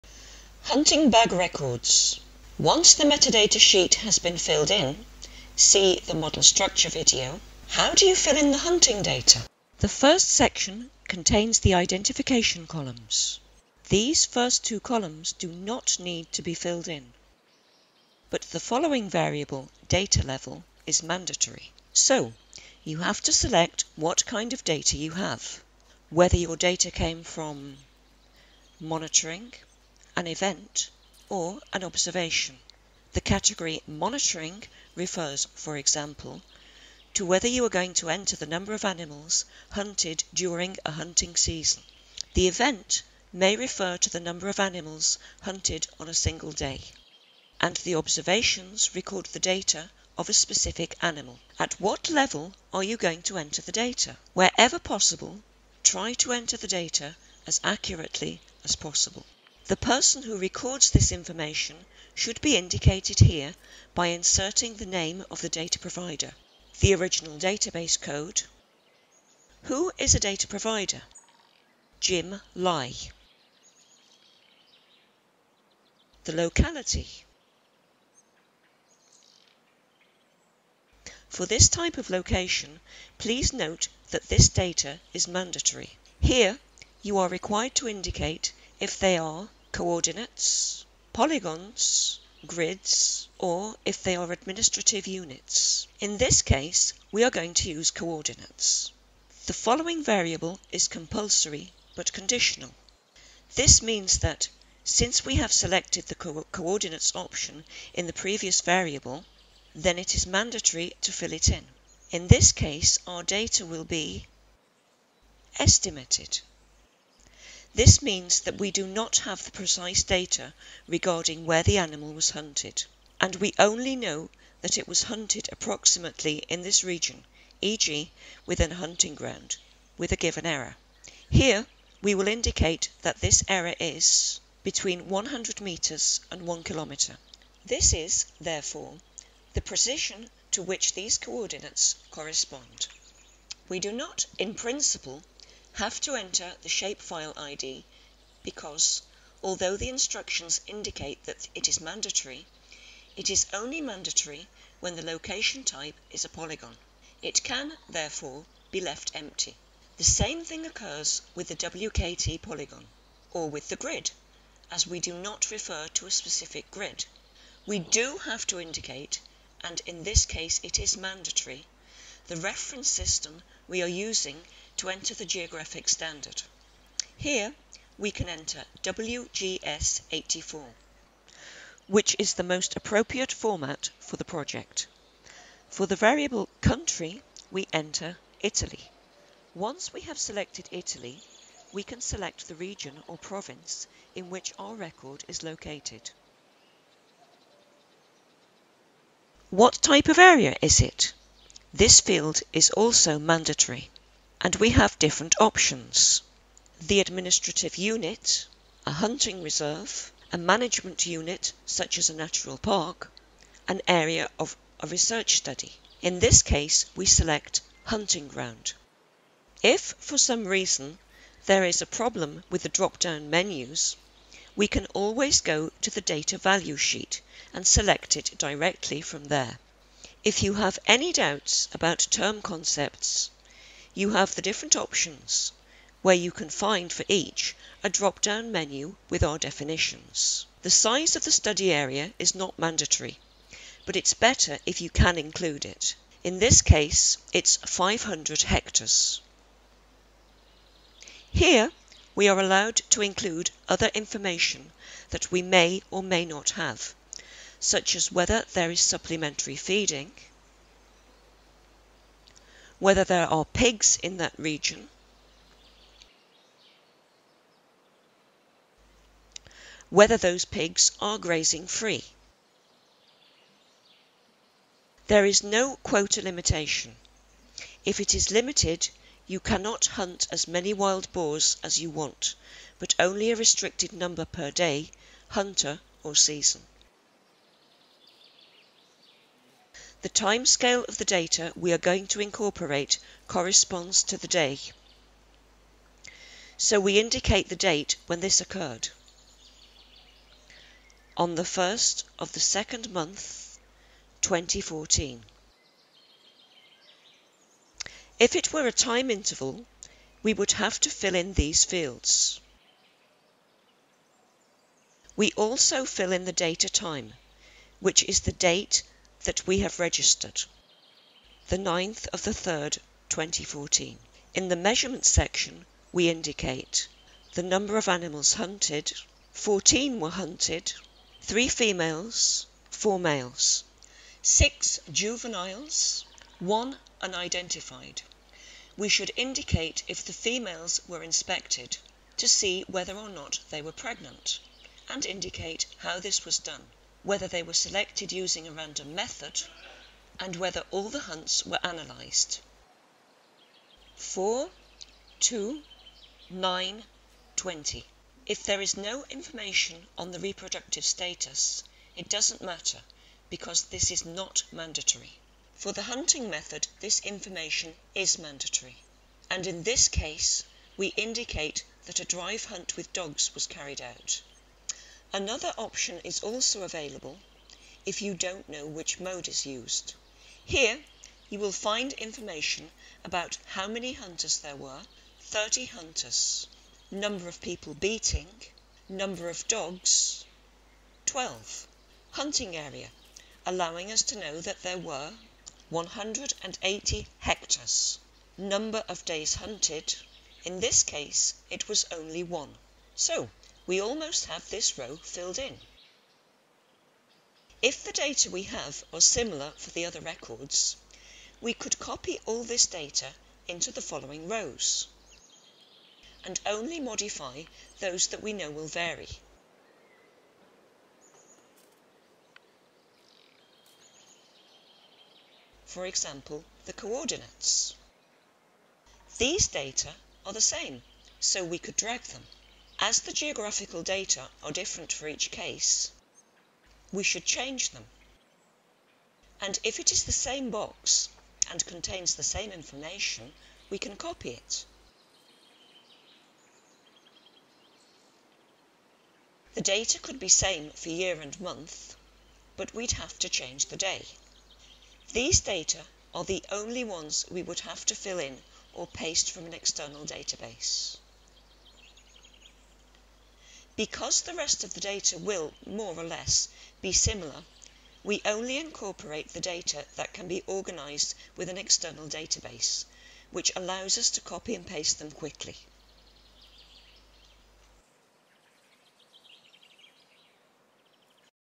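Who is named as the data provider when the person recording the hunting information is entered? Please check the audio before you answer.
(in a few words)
Jim Lai.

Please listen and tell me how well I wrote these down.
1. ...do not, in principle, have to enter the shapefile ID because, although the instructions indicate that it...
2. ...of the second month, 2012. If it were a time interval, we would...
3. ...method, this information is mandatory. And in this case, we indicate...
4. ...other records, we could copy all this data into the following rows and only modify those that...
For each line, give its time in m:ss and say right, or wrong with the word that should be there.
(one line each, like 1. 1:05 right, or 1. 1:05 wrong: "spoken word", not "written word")
1. 2:23 right
2. 5:02 wrong: "2014", not "2012"
3. 6:06 right
4. 6:49 right.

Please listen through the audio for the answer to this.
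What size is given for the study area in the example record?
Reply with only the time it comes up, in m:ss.
4:07.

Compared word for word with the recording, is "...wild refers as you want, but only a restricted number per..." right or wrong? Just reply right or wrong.
wrong.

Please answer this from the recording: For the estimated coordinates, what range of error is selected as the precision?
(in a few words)
100 metres to 1 kilometre.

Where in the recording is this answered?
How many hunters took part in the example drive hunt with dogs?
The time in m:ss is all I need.
6:25.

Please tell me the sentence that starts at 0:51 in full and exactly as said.
At what level are you going to enter the data?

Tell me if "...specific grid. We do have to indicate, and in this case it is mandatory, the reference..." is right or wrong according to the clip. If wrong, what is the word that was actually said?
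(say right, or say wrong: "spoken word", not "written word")
right.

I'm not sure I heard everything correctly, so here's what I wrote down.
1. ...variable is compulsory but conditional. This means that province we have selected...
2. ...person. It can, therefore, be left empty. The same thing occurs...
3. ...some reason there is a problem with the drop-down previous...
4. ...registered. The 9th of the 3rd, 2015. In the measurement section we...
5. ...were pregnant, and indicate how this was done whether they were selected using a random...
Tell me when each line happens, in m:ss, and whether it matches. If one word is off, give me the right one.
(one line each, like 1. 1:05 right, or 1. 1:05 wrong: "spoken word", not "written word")
1. 1:40 wrong: "since", not "province"
2. 2:36 wrong: "polygon", not "person"
3. 3:40 wrong: "menus", not "previous"
4. 5:19 wrong: "2014", not "2015"
5. 5:43 right.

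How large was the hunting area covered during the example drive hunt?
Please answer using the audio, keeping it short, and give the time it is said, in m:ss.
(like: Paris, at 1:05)
180 hectares, at 6:35.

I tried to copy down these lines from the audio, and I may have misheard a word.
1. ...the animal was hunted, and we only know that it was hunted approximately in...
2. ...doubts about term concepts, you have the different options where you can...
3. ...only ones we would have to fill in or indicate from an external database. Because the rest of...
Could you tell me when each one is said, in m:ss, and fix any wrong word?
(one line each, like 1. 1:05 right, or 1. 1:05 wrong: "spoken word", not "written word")
1. 2:01 right
2. 3:51 right
3. 7:36 wrong: "paste", not "indicate".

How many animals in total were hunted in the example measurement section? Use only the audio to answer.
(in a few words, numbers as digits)
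14.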